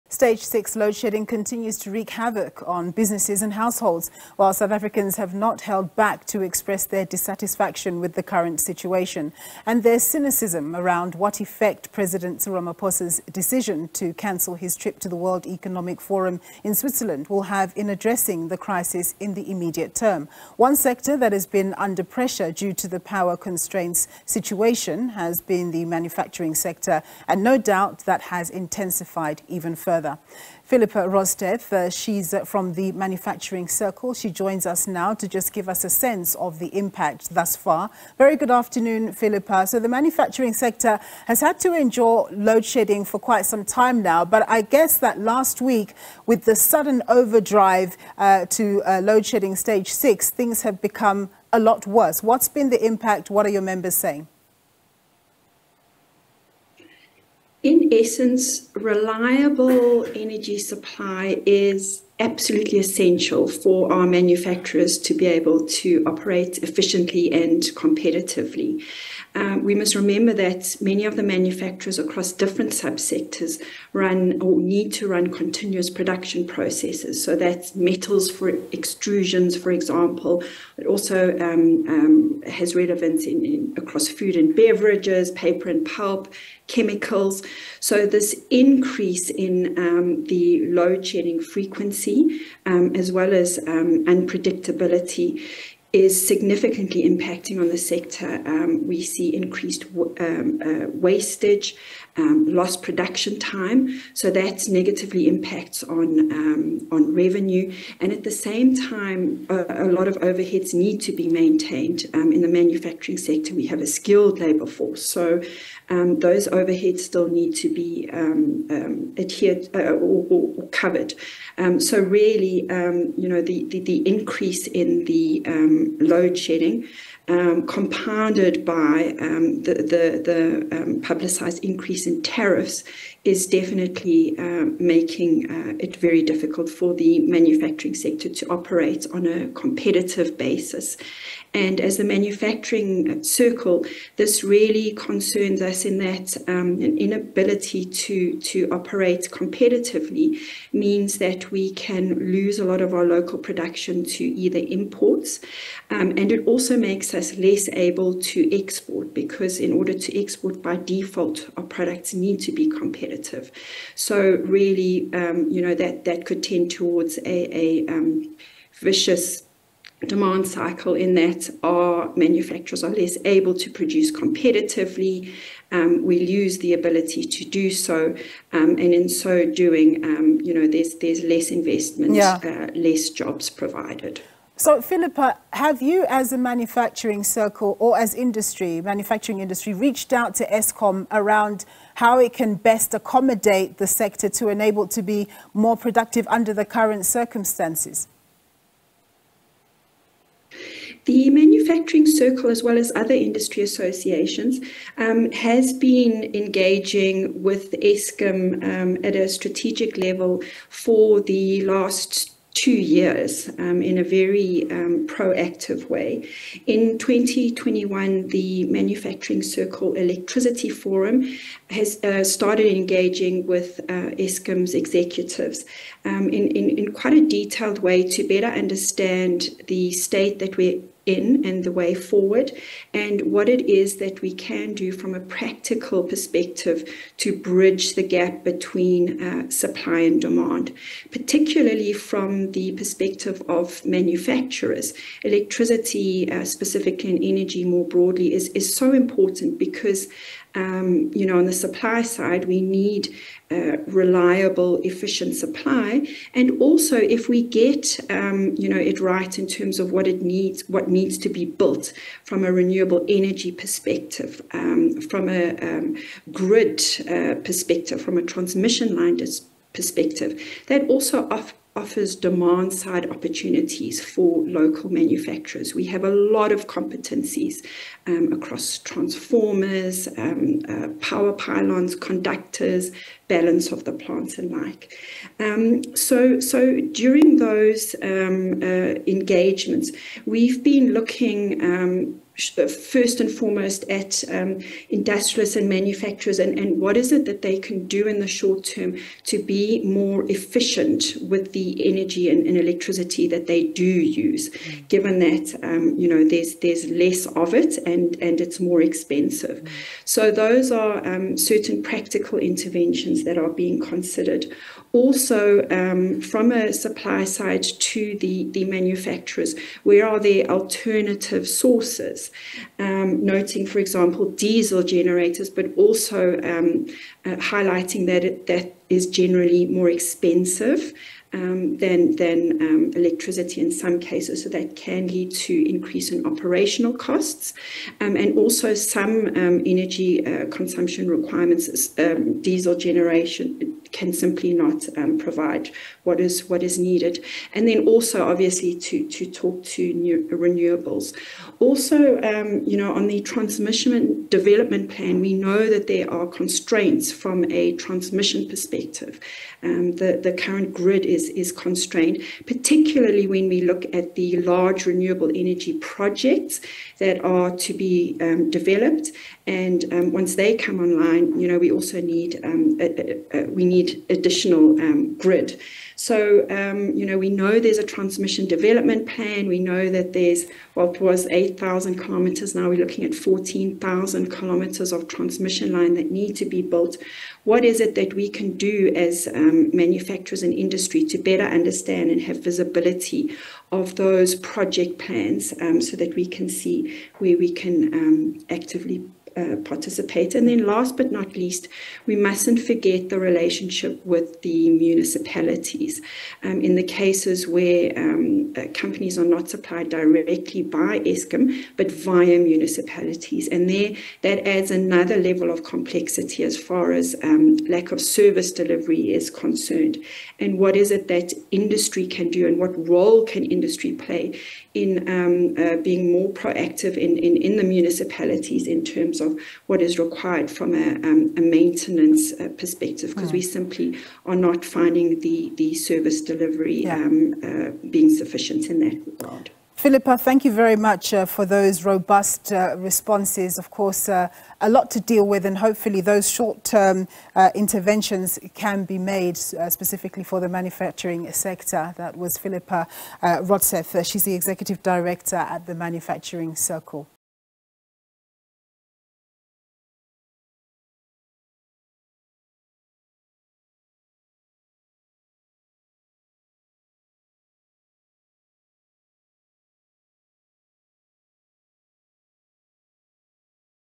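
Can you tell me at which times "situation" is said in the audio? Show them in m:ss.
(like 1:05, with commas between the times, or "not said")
0:08, 0:24.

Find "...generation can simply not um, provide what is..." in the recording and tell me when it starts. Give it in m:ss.
5:42.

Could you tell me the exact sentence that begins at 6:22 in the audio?
Now we're looking at 14,000 kilometers of transmission line that need to be built.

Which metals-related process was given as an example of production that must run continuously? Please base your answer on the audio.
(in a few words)
extrusions.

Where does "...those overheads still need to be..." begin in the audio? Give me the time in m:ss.
1:56.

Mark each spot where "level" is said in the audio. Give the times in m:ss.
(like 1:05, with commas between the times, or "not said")
3:29, 6:55.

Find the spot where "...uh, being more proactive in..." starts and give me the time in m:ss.
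7:05.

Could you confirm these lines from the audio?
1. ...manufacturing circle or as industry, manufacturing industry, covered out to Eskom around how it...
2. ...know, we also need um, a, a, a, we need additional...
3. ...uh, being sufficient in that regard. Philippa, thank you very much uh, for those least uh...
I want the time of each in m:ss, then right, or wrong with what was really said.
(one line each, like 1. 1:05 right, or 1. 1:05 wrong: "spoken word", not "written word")
1. 3:06 wrong: "reached", not "covered"
2. 6:11 right
3. 7:17 wrong: "robust", not "least".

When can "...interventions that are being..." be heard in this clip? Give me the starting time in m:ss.
5:12.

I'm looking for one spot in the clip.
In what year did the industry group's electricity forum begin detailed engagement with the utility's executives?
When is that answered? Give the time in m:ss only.
3:36.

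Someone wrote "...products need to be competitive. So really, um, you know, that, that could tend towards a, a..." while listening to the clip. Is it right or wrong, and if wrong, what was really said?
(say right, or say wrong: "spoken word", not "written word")
right.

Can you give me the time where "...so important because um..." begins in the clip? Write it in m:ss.
4:08.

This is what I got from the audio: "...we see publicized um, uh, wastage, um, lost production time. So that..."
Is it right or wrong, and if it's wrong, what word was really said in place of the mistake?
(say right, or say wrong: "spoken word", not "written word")
wrong: "increased", not "publicized".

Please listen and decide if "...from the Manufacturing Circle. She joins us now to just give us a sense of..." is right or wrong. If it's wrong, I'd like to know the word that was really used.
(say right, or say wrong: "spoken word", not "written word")
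right.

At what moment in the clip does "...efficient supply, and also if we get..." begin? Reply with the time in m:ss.
4:14.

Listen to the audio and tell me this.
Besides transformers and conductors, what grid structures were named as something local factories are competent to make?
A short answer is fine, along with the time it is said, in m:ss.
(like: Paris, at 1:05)
power pylons, at 4:40.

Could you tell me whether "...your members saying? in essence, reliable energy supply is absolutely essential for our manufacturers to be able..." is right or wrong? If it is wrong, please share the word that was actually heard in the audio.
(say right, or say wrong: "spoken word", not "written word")
right.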